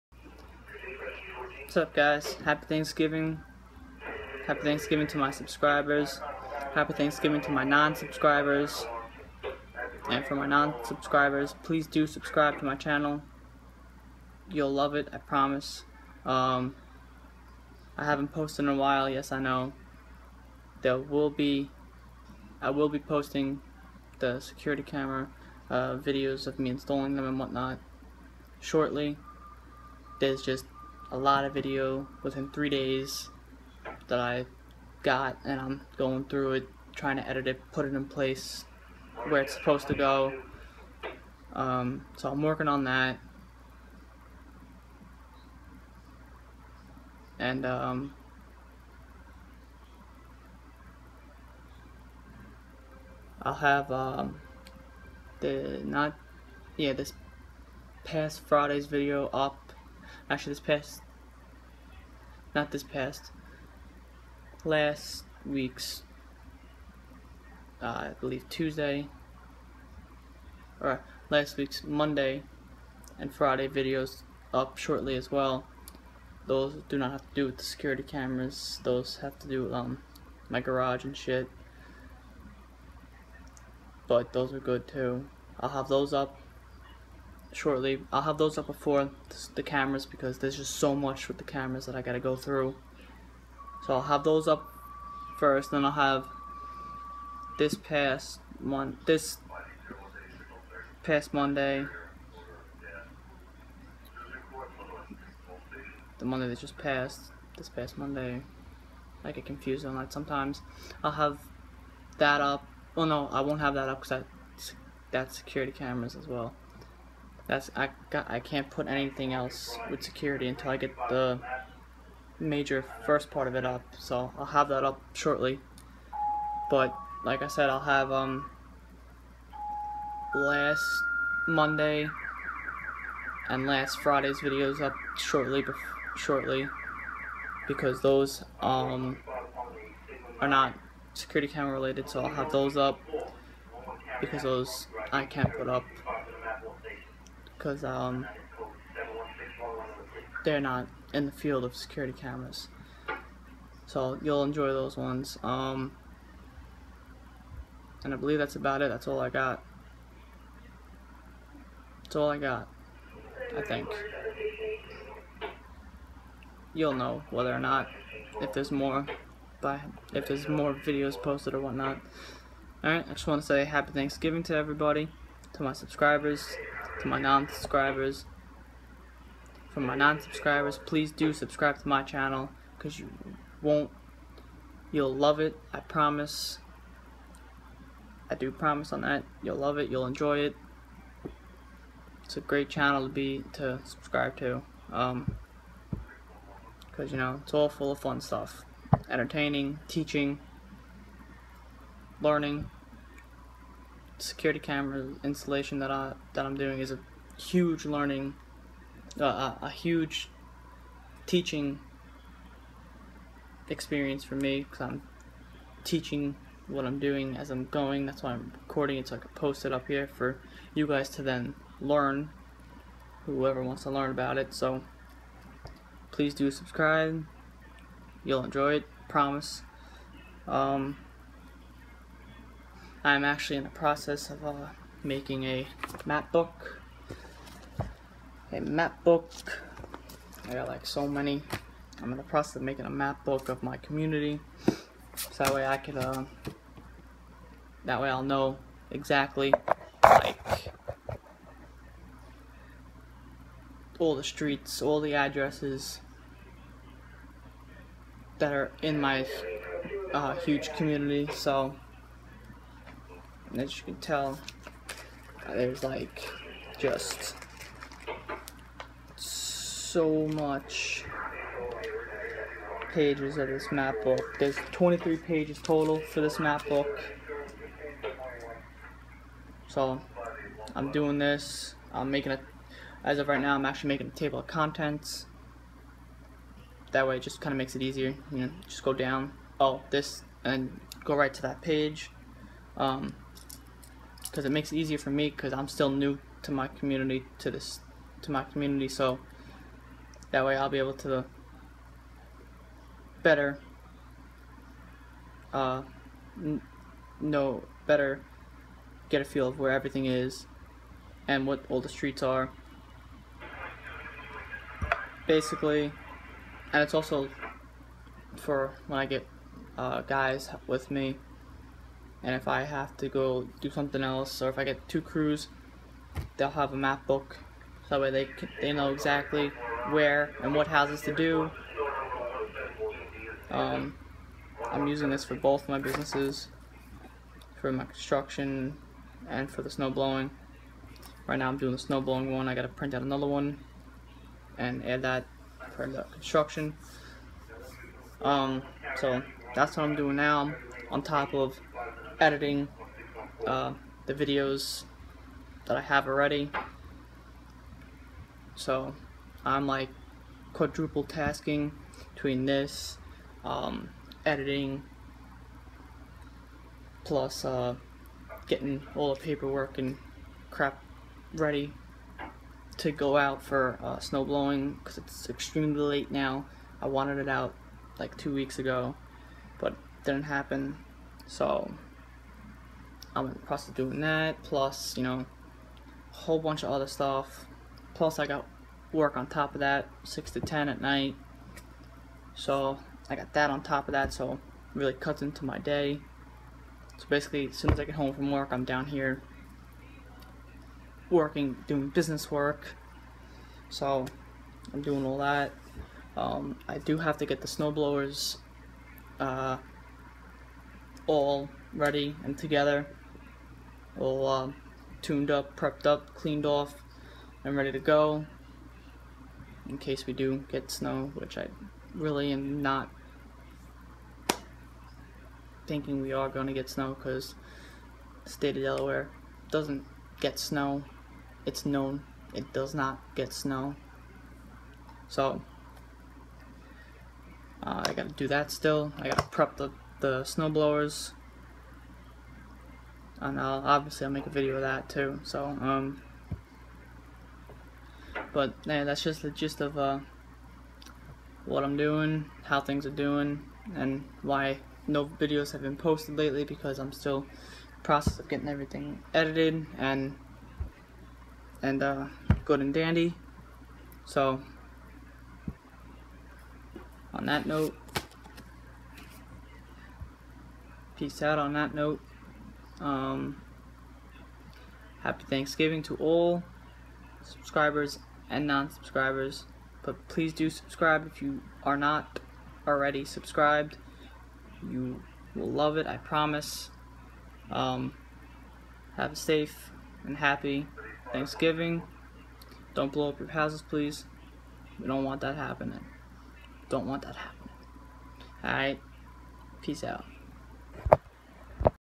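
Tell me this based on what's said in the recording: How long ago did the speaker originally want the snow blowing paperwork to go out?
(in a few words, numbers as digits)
two weeks ago.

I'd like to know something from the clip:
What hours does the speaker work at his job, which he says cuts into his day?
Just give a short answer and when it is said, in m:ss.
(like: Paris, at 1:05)
6 to 10 at night, at 6:30.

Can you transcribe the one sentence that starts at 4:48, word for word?
You know, just go down, oh, this, and go right to that page.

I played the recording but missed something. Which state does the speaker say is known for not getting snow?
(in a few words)
Delaware.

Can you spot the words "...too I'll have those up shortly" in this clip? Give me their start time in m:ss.
1:24.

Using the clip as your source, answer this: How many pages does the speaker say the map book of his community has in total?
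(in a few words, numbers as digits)
23.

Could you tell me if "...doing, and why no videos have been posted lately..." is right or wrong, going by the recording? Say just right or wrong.
right.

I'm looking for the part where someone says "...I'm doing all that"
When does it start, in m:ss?
6:44.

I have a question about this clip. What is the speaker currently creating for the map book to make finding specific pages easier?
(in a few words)
table of contents.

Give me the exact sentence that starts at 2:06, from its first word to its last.
But like I said, I'll have um last Monday and last Friday's videos up shortly.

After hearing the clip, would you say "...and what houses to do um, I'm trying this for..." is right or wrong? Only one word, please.
wrong.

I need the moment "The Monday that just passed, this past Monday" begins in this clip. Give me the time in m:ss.
1:46.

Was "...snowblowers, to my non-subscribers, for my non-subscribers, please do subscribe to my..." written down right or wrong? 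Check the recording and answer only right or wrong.
wrong.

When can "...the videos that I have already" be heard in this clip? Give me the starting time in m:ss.
5:54.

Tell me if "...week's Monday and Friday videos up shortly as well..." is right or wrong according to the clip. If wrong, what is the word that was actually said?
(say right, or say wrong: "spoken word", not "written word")
right.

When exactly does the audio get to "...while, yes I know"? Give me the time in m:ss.
0:18.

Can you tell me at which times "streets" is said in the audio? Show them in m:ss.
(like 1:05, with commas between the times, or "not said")
4:14, 5:11.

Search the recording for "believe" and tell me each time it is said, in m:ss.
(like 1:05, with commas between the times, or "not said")
1:08, 2:38.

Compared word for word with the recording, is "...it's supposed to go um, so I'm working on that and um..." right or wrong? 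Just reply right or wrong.
right.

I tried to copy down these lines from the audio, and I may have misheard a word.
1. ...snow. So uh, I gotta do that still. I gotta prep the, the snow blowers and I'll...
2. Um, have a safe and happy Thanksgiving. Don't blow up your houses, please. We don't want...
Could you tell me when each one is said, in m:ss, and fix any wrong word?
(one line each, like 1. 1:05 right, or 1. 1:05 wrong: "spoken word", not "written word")
1. 7:13 right
2. 8:07 right.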